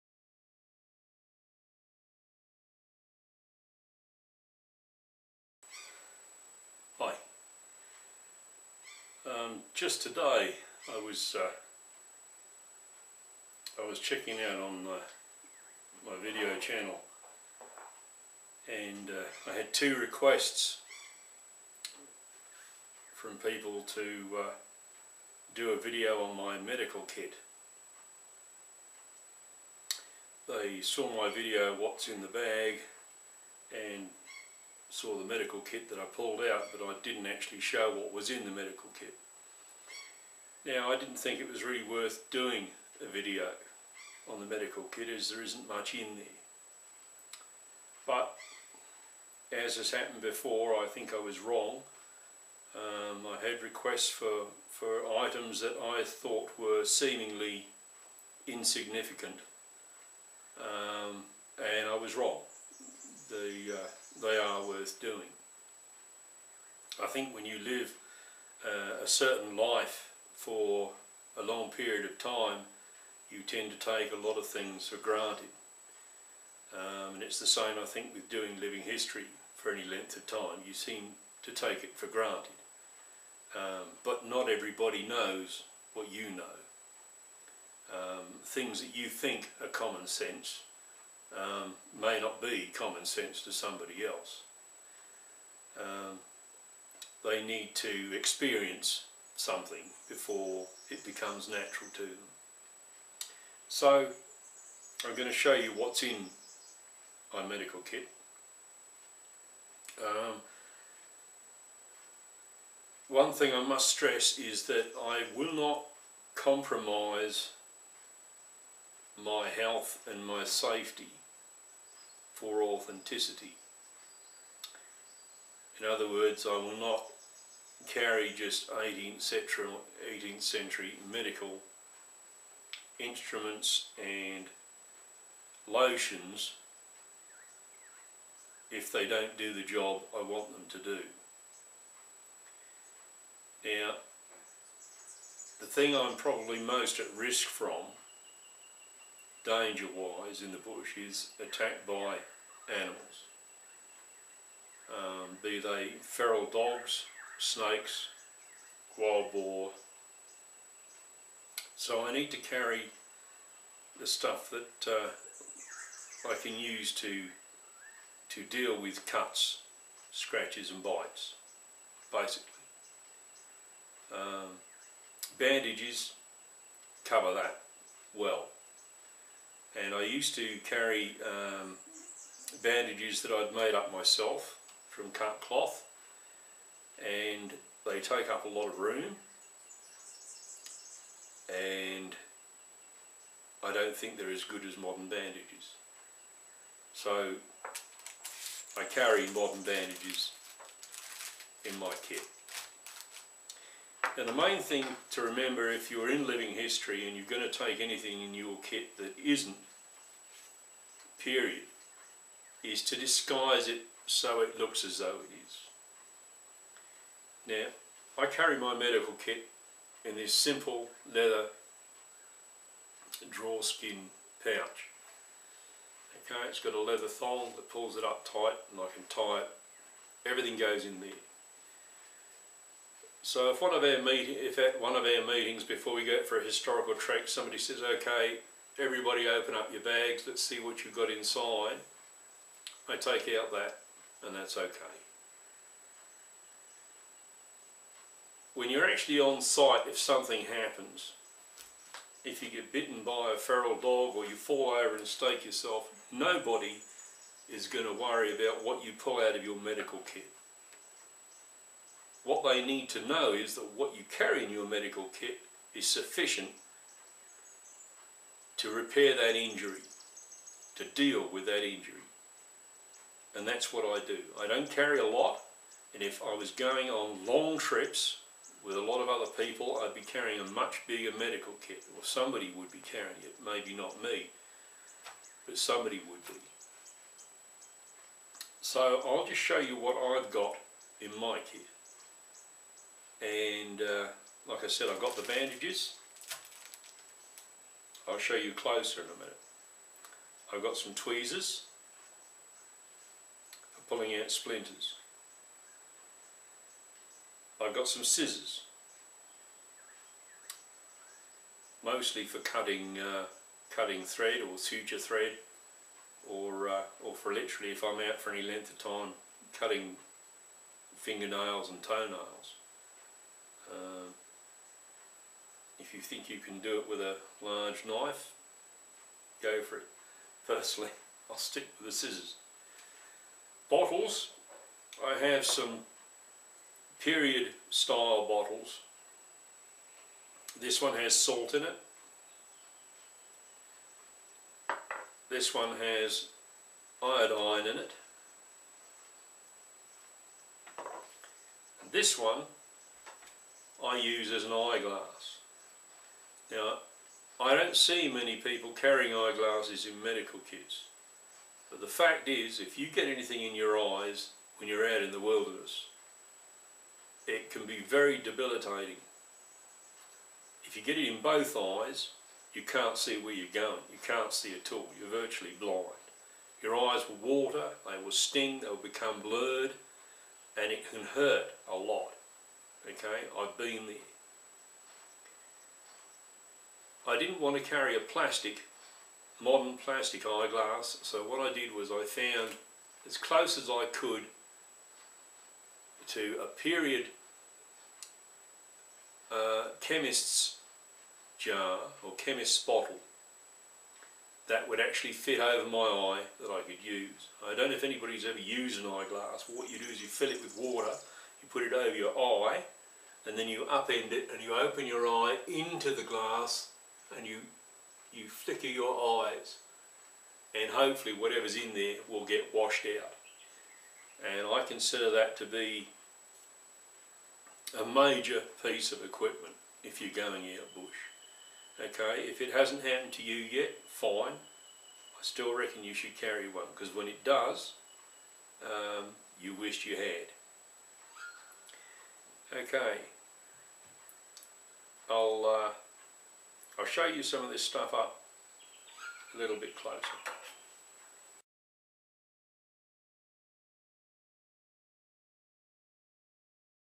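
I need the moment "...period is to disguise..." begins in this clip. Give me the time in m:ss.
3:31.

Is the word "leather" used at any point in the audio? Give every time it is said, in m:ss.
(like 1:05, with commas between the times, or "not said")
3:41, 3:46.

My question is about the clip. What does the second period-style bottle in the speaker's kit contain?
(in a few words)
Iodine.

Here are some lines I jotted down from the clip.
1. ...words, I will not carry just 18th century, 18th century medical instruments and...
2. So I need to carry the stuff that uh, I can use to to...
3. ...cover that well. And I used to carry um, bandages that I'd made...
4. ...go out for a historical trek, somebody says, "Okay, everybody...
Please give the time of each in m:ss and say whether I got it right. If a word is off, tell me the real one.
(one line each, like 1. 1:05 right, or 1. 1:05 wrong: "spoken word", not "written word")
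1. 2:06 right
2. 2:41 right
3. 2:57 right
4. 3:56 right.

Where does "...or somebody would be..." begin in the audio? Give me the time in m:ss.
4:41.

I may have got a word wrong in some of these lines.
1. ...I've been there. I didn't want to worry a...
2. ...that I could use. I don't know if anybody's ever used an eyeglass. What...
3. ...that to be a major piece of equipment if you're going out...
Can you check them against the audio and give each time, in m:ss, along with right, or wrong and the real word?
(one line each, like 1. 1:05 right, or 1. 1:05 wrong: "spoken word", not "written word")
1. 6:23 wrong: "carry", not "worry"
2. 6:46 right
3. 7:05 right.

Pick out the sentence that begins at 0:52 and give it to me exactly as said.
Um, I had requests for, for items that I thought were seemingly insignificant.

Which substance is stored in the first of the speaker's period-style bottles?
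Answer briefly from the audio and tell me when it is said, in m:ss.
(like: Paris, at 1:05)
Salt, at 5:41.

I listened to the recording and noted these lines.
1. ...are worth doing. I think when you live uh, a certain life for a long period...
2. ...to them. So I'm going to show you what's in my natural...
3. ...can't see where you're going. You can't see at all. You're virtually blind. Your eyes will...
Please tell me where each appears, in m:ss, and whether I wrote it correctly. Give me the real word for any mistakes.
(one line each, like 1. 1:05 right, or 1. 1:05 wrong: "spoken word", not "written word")
1. 1:04 right
2. 1:41 wrong: "medical", not "natural"
3. 6:12 right.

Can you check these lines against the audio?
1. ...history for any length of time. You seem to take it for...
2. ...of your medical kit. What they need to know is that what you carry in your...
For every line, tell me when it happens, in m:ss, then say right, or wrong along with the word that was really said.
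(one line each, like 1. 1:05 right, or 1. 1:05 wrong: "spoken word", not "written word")
1. 1:18 right
2. 4:19 right.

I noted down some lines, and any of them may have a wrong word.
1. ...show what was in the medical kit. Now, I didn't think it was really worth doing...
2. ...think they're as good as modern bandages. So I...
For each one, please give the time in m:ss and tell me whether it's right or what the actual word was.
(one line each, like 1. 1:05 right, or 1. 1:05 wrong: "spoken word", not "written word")
1. 0:37 right
2. 3:13 right.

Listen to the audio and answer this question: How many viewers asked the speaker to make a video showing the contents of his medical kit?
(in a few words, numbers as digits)
2.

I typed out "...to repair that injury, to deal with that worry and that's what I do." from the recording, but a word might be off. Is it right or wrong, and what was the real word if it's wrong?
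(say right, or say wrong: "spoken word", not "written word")
wrong: "injury", not "worry".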